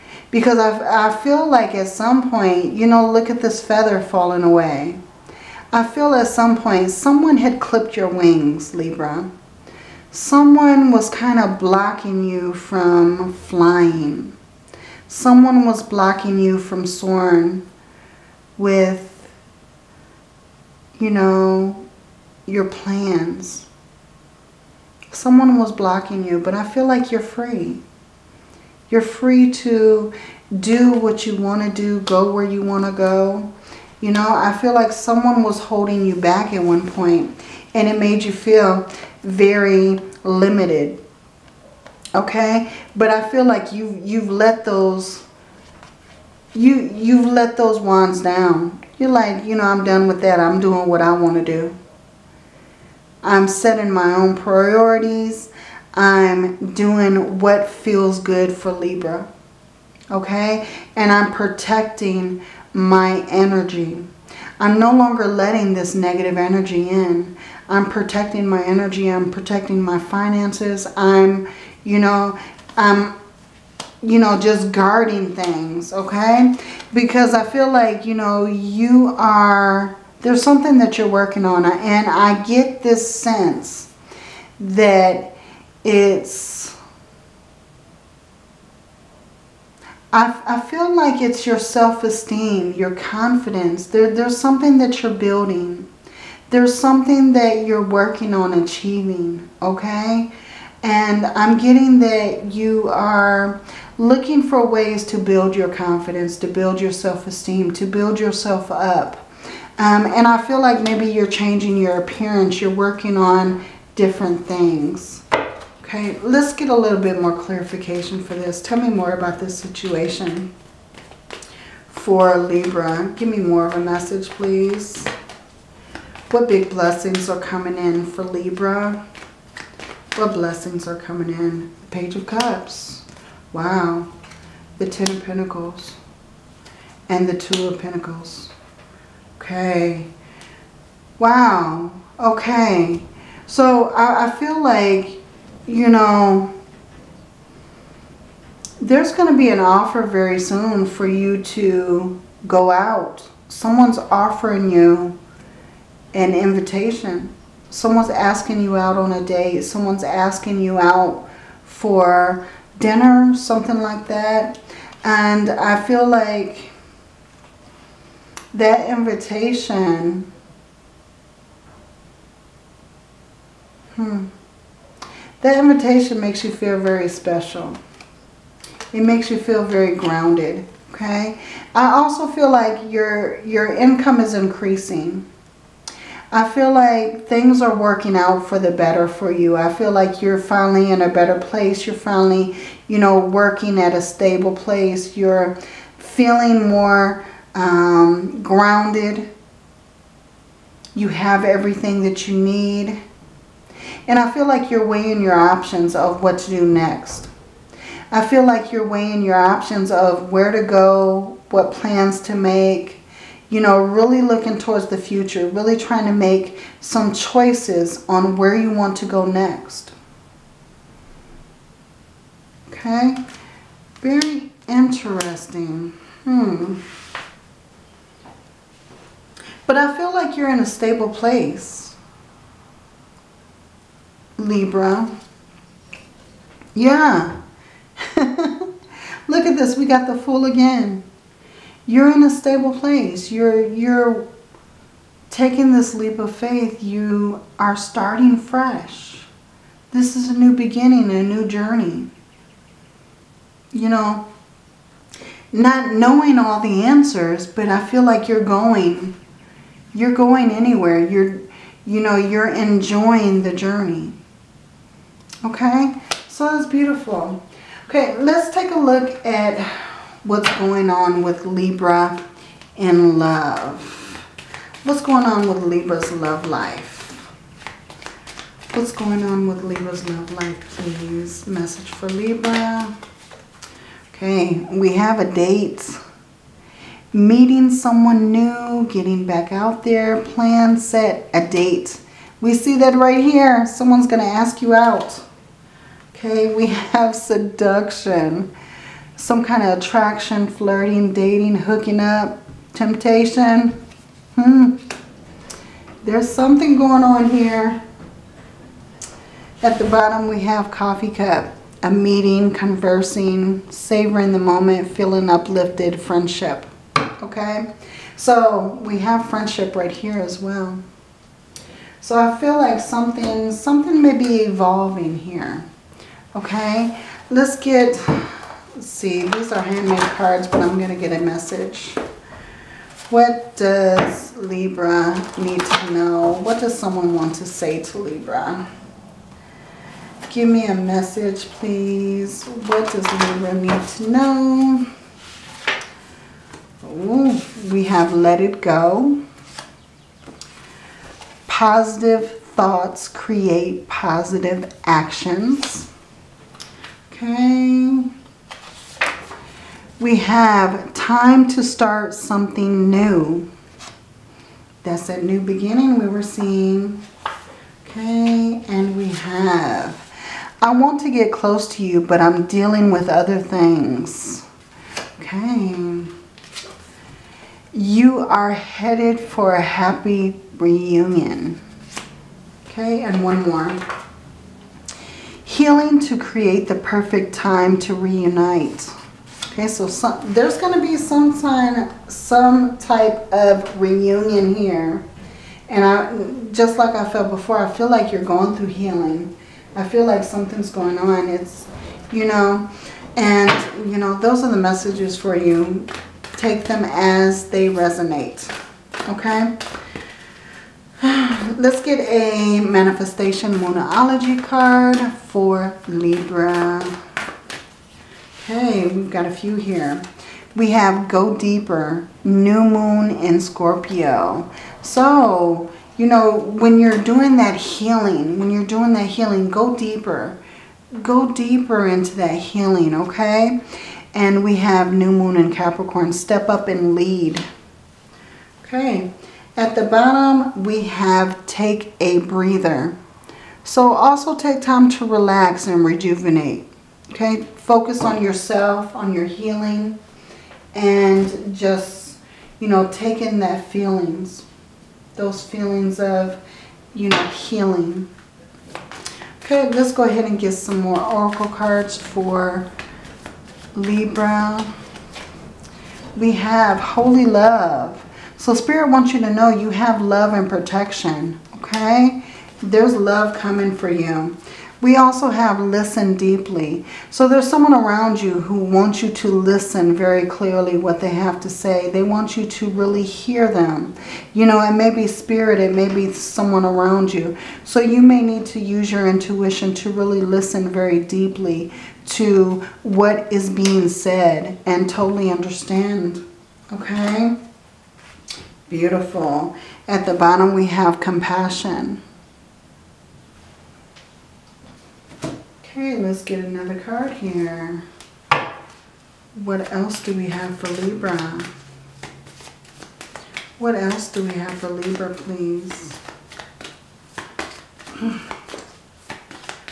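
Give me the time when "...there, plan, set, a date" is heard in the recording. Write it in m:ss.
4:49.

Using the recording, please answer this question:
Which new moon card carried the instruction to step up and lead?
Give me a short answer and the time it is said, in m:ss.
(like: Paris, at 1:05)
New Moon in Capricorn, at 7:14.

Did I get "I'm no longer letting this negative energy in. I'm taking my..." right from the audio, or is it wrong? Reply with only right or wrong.
wrong.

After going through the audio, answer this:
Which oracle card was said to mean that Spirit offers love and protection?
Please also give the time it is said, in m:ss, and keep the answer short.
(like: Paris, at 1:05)
Holy Love, at 7:46.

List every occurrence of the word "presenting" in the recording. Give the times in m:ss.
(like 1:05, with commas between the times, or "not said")
not said.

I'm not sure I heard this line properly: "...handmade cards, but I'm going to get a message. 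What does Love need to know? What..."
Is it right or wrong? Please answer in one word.
wrong.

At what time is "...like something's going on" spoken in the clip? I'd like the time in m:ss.
6:40.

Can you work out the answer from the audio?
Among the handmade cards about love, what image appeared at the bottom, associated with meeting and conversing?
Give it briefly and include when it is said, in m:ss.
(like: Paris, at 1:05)
Coffee cup, at 5:10.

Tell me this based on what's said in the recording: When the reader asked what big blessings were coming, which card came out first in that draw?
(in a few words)
Page of Cups.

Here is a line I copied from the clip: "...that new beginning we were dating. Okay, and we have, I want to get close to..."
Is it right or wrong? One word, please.
wrong.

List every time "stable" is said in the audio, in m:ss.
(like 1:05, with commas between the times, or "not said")
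3:14, 3:50, 4:02.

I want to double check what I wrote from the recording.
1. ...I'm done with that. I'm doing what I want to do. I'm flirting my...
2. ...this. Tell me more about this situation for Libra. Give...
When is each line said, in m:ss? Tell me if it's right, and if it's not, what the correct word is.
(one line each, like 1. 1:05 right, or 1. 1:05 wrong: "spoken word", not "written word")
1. 0:49 wrong: "setting", not "flirting"
2. 1:58 right.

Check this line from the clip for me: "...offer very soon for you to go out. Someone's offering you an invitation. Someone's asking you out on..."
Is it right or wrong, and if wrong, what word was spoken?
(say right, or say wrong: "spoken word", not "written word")
right.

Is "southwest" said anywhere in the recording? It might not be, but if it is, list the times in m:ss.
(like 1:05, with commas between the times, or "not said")
not said.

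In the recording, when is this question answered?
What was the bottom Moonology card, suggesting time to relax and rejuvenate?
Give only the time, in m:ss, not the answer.
7:21.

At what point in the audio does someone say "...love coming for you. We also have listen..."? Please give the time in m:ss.
7:52.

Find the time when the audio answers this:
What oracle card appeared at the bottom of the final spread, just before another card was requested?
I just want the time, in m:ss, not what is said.
8:20.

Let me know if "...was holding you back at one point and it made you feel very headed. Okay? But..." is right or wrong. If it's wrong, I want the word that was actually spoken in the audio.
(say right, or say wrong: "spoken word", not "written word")
wrong: "limited", not "headed".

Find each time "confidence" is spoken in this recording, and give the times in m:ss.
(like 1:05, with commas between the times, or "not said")
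1:32, 1:45.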